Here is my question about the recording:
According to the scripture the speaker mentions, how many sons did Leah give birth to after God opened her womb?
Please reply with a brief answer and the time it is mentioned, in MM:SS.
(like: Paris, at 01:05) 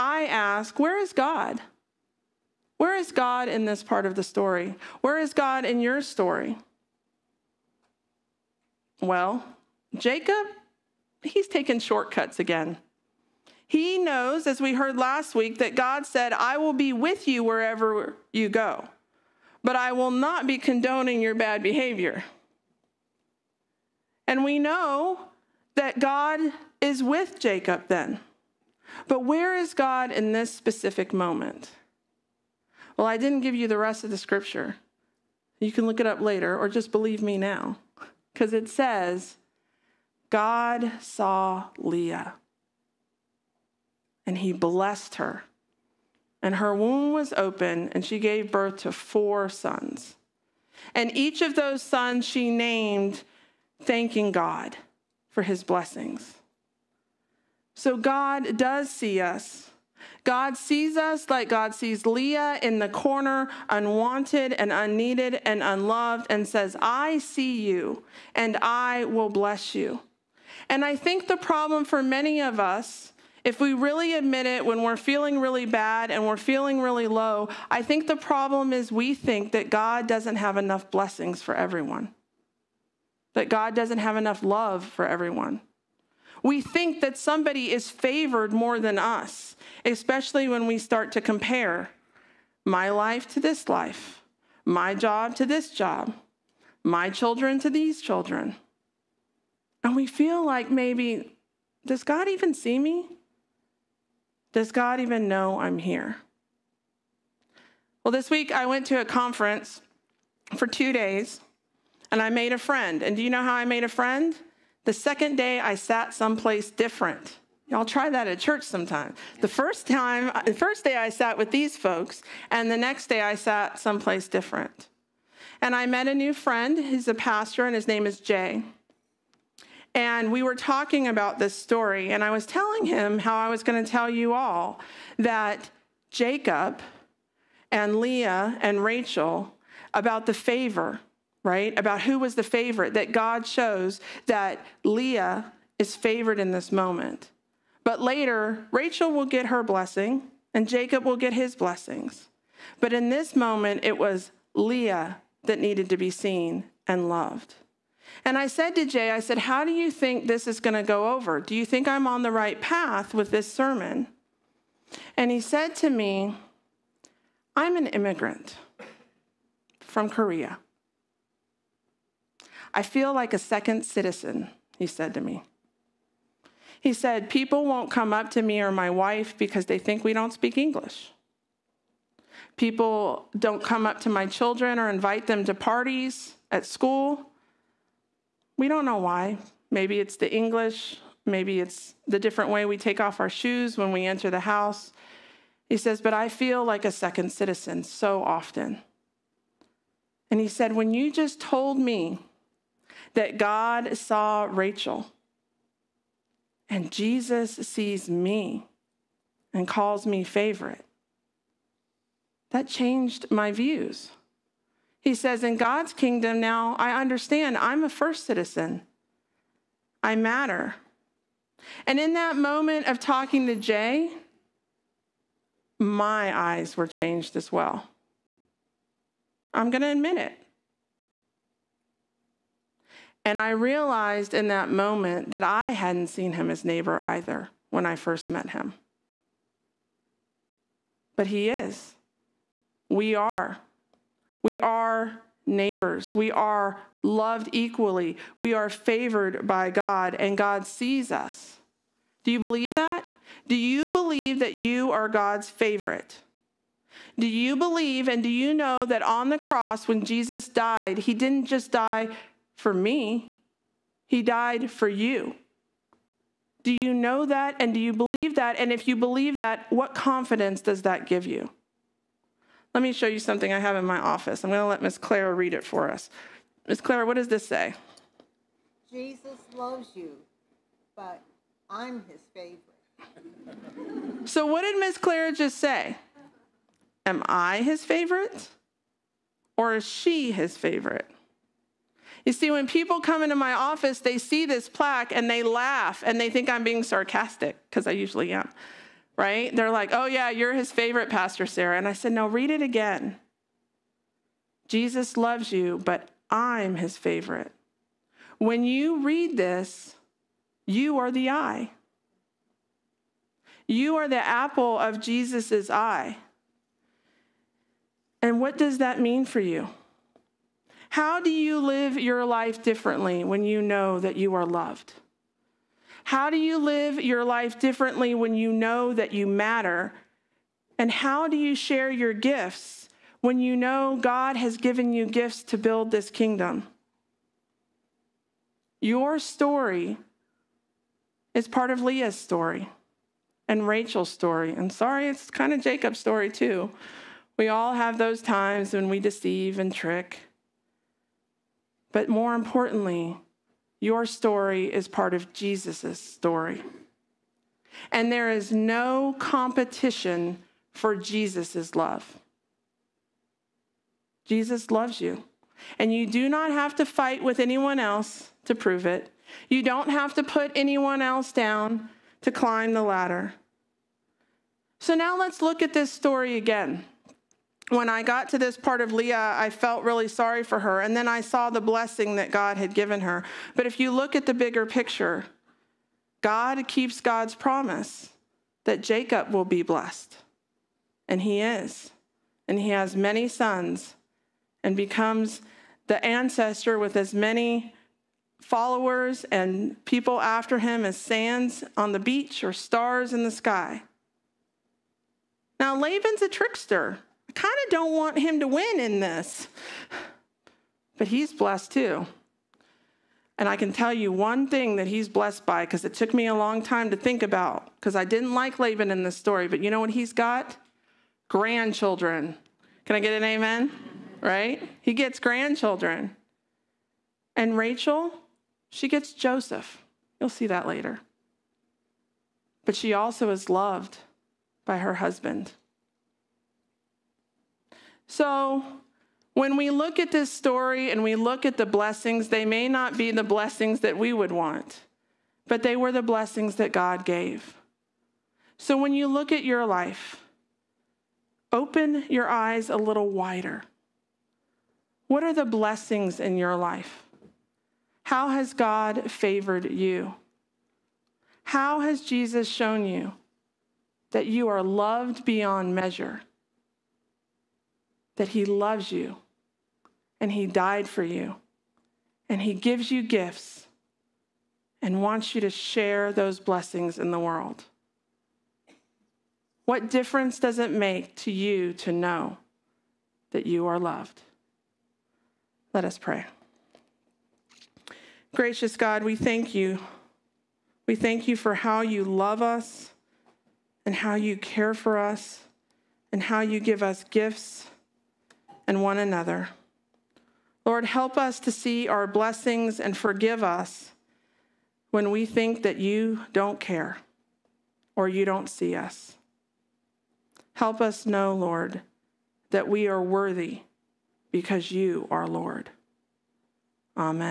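4, at 00:48.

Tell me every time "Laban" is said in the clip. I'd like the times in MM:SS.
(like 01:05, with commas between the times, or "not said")
06:45, 06:58.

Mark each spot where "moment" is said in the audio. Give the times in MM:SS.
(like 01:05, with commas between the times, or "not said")
00:31, 02:26, 02:33, 03:42, 03:54.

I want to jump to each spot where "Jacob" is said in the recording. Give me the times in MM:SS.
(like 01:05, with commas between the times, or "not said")
00:09, 00:27, 02:16, 02:30, 05:45, 06:28.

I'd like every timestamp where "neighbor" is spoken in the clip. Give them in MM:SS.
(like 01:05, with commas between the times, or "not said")
03:56, 04:05.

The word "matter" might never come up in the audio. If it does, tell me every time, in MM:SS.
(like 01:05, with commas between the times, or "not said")
03:40, 05:29.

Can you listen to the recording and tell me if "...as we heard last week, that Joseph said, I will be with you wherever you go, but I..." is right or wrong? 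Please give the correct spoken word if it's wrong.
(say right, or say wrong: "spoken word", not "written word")
wrong: "God", not "Joseph".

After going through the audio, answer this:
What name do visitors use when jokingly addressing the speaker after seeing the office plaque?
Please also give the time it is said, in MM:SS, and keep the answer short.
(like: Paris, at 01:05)
Pastor Sarah, at 05:01.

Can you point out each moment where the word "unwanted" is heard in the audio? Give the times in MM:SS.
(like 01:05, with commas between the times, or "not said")
01:03.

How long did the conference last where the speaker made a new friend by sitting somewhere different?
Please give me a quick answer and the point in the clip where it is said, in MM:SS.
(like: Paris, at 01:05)
2 days, at 01:50.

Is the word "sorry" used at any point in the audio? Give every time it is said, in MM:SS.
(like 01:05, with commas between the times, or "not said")
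05:44, 06:20.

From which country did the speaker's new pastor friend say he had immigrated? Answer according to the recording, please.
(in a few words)
Korea.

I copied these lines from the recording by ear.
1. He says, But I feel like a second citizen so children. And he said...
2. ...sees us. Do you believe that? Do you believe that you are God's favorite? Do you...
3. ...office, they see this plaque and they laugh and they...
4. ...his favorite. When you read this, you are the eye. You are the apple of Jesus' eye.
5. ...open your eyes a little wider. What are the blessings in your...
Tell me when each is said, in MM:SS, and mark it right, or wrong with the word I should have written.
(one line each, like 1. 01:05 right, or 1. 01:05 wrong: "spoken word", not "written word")
1. 03:15 wrong: "often", not "children"
2. 04:10 right
3. 04:53 right
4. 05:06 right
5. 07:31 right.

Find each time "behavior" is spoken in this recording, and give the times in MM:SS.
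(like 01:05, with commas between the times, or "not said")
00:21.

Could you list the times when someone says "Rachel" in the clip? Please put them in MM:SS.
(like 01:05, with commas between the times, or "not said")
02:18, 02:28, 03:24, 05:43, 07:07.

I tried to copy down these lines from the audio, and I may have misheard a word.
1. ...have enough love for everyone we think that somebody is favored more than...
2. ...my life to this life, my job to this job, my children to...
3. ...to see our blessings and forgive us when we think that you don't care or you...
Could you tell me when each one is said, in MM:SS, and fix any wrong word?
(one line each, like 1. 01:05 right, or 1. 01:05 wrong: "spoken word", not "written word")
1. 01:23 right
2. 01:32 right
3. 08:21 right.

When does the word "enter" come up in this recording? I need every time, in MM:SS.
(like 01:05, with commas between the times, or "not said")
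03:14.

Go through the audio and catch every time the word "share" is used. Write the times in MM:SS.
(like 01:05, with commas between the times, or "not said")
05:31, 07:55.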